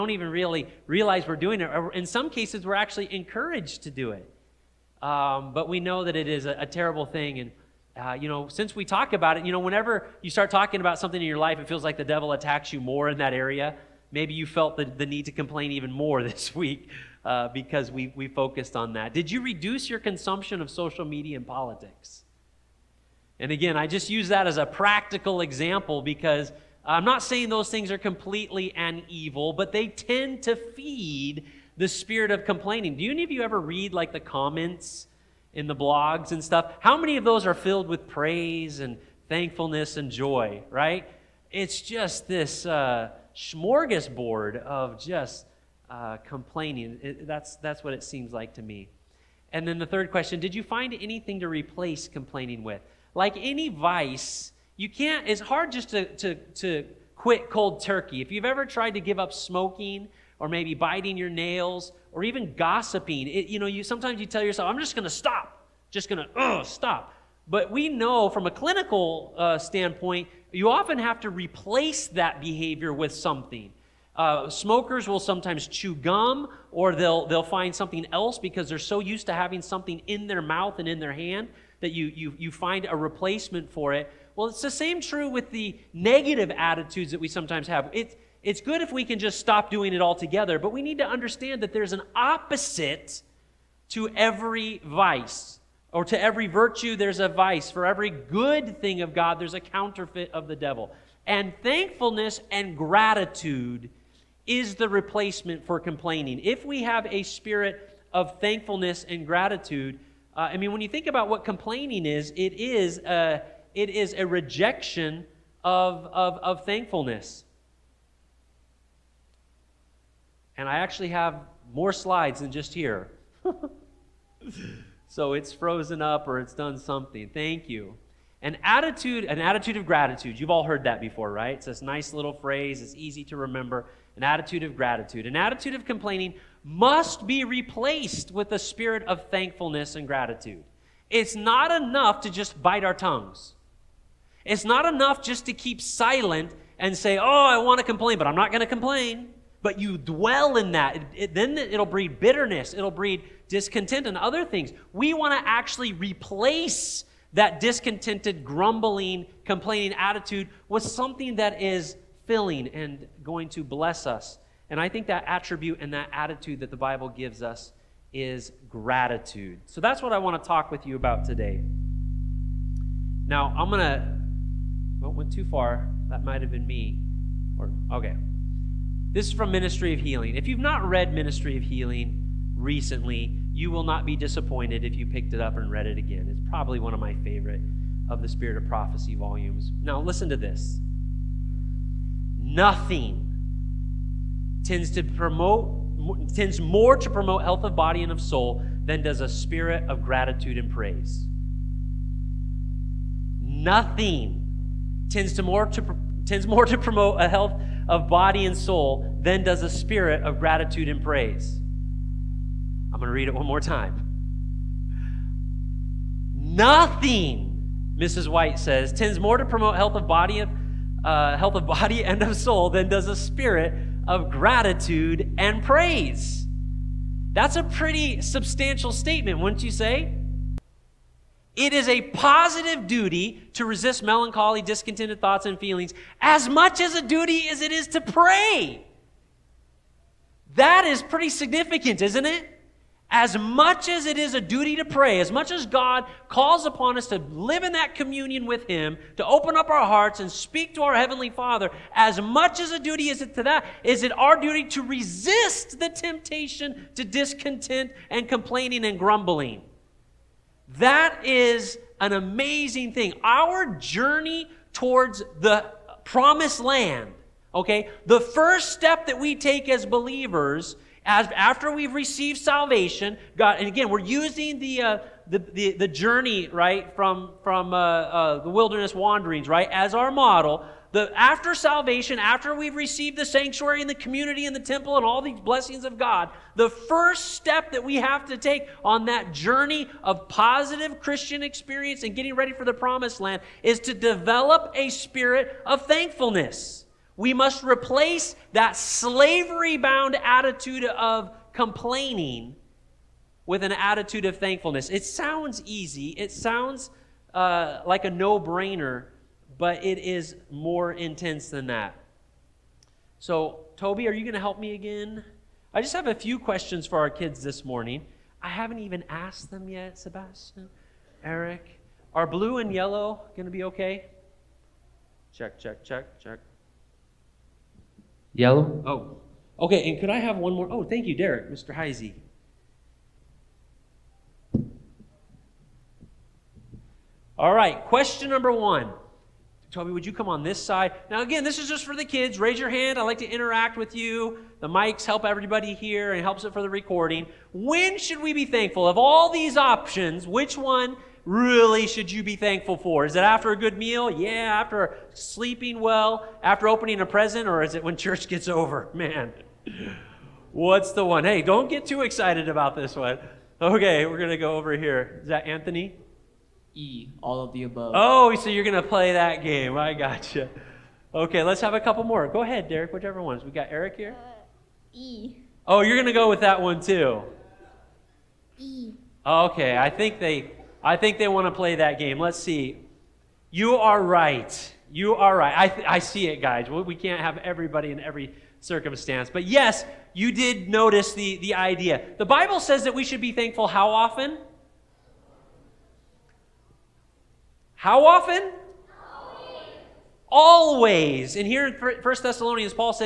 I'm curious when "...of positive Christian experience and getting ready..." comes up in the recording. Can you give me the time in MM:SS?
04:50.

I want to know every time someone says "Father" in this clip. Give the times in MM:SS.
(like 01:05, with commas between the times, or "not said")
04:11.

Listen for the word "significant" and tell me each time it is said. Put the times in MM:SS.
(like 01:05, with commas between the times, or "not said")
04:01.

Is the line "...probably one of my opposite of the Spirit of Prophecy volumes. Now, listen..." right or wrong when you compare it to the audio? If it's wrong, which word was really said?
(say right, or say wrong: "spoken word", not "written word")
wrong: "favorite", not "opposite".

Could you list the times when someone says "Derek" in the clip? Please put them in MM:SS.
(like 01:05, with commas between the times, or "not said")
05:31, 06:12.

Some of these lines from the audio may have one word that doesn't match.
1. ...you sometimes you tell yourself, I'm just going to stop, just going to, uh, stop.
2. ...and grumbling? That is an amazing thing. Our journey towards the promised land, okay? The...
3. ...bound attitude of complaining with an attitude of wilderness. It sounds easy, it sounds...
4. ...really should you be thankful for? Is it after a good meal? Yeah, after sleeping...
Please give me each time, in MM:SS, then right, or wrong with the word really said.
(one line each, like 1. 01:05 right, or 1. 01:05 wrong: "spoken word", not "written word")
1. 01:03 right
2. 04:18 right
3. 04:59 wrong: "thankfulness", not "wilderness"
4. 05:51 right.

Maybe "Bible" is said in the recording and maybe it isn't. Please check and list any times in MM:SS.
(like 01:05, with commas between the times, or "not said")
02:46, 06:32.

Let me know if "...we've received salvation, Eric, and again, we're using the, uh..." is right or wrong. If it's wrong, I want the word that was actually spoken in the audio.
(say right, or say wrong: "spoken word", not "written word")
wrong: "God", not "Eric".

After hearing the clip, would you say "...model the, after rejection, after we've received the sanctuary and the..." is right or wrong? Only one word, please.
wrong.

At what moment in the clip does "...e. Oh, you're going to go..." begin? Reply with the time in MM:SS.
06:14.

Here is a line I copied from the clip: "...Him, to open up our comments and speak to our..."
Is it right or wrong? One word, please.
wrong.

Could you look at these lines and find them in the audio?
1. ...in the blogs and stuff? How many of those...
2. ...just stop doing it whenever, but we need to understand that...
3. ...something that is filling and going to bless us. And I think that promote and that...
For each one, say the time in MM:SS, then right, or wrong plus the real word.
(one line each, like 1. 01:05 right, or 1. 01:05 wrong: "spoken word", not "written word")
1. 00:35 right
2. 01:29 wrong: "altogether", not "whenever"
3. 02:40 wrong: "attribute", not "promote".